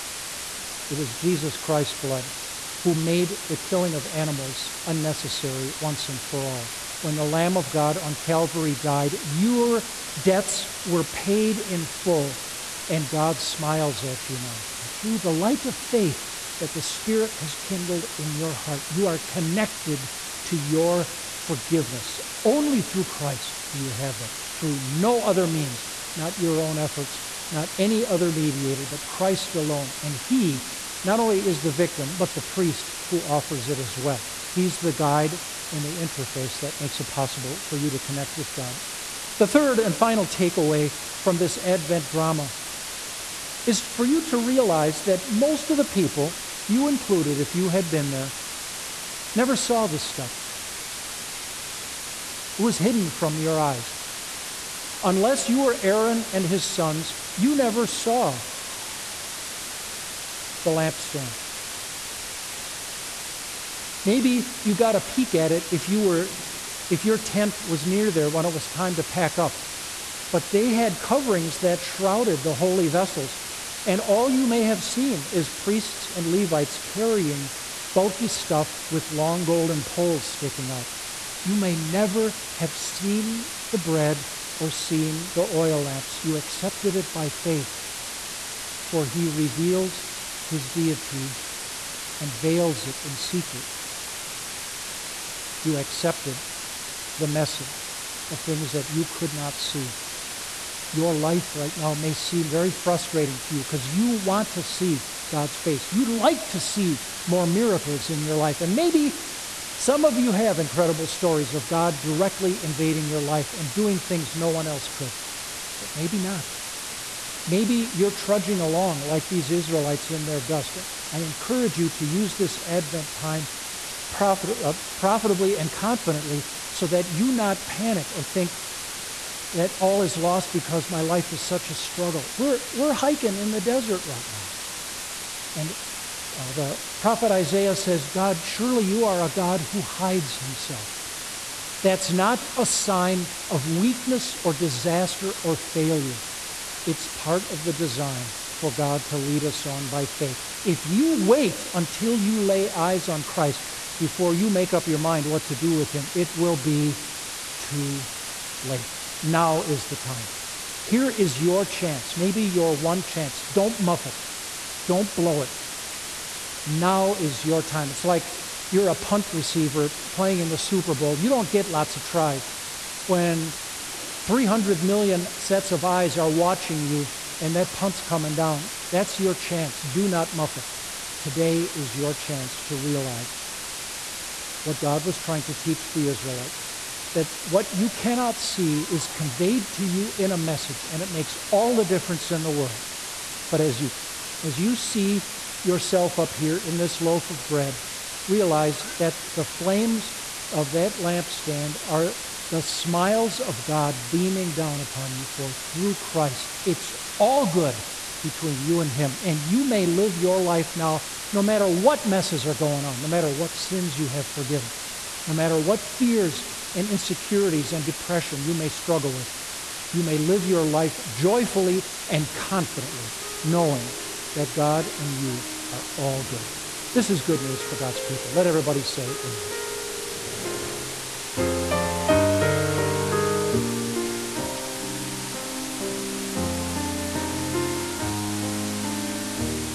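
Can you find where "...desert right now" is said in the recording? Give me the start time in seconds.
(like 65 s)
133 s.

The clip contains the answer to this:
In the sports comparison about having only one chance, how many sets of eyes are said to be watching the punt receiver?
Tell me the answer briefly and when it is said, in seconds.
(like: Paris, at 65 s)
300 million, at 174 s.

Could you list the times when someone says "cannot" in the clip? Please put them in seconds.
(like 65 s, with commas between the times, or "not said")
187 s.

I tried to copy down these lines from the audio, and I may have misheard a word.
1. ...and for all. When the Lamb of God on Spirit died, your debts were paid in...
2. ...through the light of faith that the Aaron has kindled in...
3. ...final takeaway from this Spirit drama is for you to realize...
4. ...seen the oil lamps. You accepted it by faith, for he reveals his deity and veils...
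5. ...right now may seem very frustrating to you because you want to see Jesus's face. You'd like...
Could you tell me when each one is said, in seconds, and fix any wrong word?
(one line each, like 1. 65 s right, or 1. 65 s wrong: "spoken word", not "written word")
1. 6 s wrong: "Calvary", not "Spirit"
2. 14 s wrong: "Spirit", not "Aaron"
3. 39 s wrong: "Advent", not "Spirit"
4. 84 s right
5. 101 s wrong: "God", not "Jesus".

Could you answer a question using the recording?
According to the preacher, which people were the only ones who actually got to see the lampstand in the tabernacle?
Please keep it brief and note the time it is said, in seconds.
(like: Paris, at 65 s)
Aaron and his sons, at 55 s.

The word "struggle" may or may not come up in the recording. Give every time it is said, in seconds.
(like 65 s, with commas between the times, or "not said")
131 s, 218 s.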